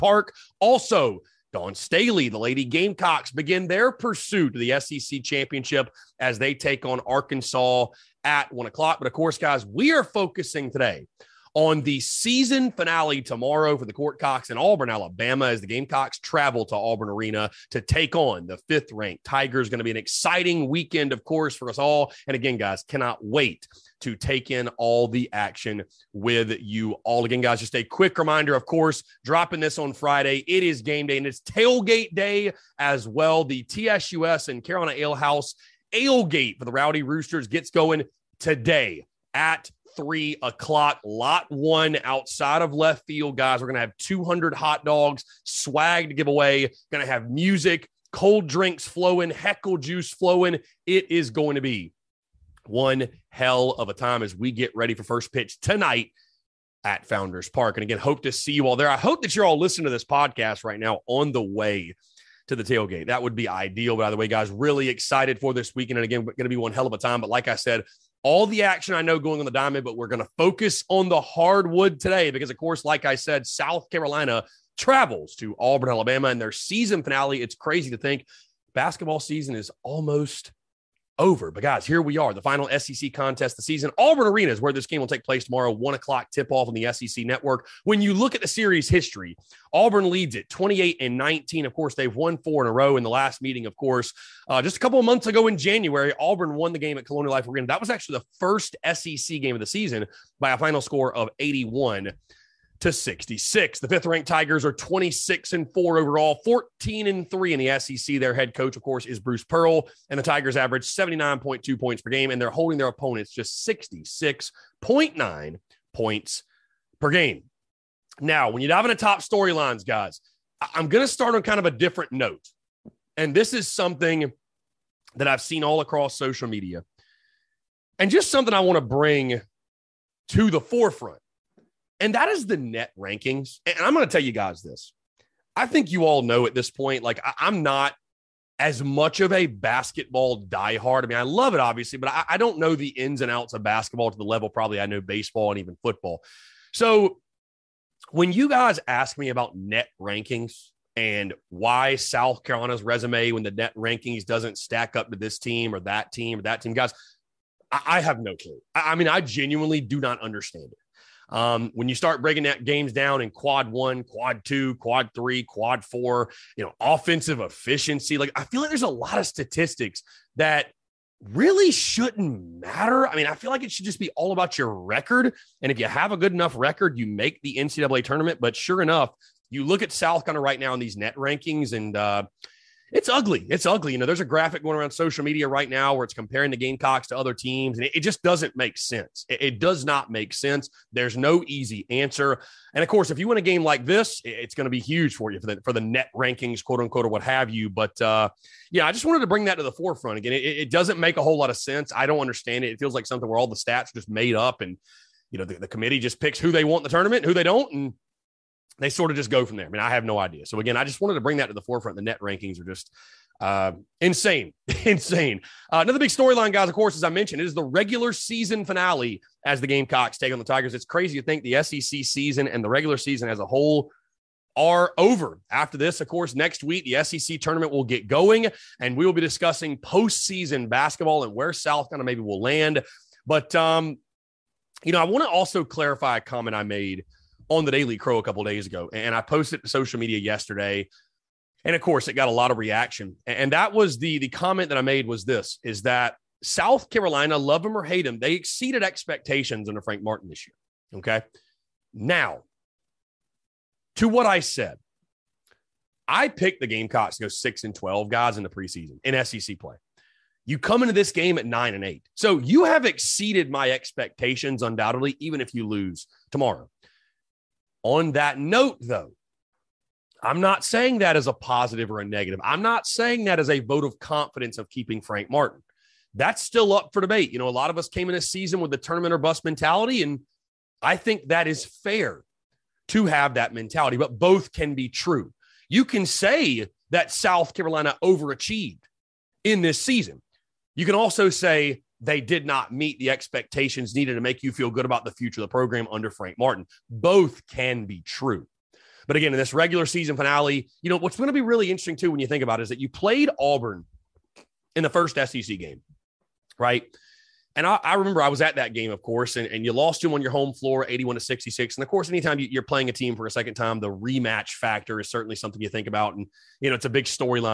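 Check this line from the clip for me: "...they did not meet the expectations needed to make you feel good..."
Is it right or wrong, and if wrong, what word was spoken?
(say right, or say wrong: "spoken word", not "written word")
right.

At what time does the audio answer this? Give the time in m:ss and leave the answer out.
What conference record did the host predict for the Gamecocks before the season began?
4:17.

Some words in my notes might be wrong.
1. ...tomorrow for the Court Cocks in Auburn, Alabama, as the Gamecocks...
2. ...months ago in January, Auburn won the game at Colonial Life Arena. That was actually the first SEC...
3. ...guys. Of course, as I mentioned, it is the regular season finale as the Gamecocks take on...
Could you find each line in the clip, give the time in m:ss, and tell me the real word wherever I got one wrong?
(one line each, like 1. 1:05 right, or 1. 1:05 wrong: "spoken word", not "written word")
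1. 0:13 right
2. 1:35 right
3. 3:36 right.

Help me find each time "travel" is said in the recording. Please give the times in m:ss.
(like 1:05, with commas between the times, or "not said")
0:16, 1:14.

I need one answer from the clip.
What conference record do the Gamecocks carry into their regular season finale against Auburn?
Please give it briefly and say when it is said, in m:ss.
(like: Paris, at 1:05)
9-8, at 4:21.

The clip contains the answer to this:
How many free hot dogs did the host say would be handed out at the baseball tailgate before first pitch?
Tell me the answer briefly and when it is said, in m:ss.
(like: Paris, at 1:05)
200, at 0:43.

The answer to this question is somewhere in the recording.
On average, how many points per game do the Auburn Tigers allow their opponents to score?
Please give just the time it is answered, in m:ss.
1:53.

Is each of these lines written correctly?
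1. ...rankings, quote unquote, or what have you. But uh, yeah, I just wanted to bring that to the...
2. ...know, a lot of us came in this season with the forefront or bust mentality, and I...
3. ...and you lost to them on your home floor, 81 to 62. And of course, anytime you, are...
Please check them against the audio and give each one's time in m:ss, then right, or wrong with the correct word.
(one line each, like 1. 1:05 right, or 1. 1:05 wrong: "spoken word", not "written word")
1. 3:16 right
2. 4:37 wrong: "tournament", not "forefront"
3. 5:09 wrong: "66", not "62".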